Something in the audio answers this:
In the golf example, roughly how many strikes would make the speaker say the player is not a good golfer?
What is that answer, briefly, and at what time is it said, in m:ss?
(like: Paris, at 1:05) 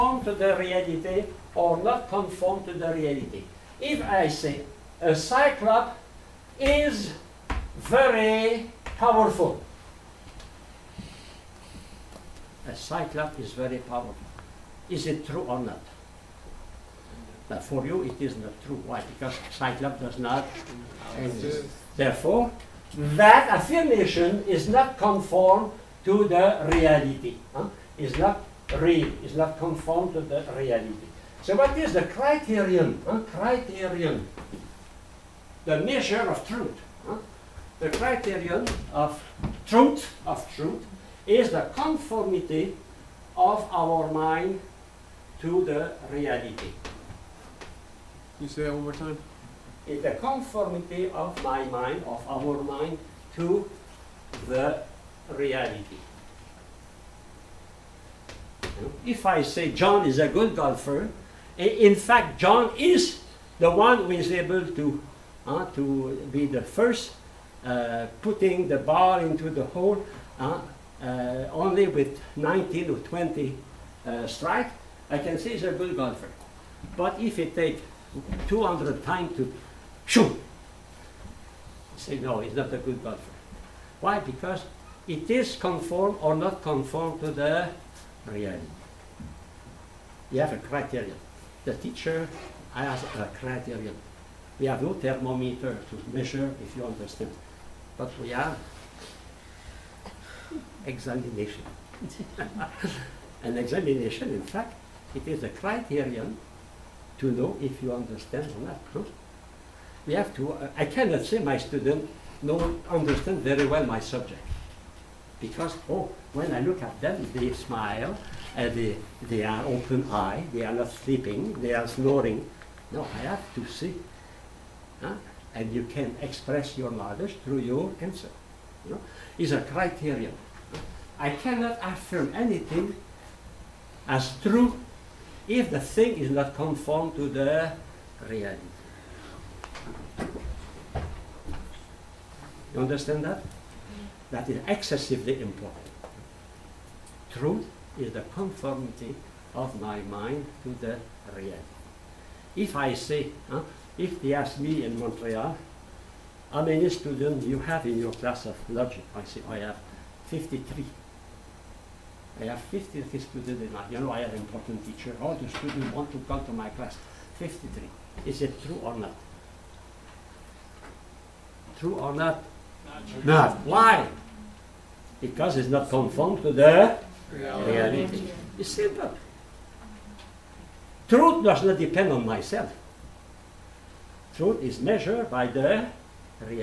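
200, at 1:18.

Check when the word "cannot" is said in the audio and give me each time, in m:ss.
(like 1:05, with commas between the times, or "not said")
1:50, 2:11.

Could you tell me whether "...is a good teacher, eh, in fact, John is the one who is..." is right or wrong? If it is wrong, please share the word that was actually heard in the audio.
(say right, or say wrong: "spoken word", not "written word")
wrong: "golfer", not "teacher".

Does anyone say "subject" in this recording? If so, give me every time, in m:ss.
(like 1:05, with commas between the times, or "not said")
1:54.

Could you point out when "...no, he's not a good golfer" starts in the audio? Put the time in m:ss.
1:22.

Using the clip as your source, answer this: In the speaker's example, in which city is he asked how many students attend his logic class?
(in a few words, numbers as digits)
Montreal.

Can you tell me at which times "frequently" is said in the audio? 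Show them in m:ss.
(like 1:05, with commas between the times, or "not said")
not said.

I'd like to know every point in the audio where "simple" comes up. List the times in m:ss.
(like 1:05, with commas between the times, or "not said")
2:58.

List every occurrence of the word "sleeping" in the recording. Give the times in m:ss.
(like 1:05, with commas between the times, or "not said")
2:00.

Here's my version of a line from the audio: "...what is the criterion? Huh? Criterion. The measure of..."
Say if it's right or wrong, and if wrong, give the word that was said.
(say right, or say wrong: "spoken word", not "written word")
right.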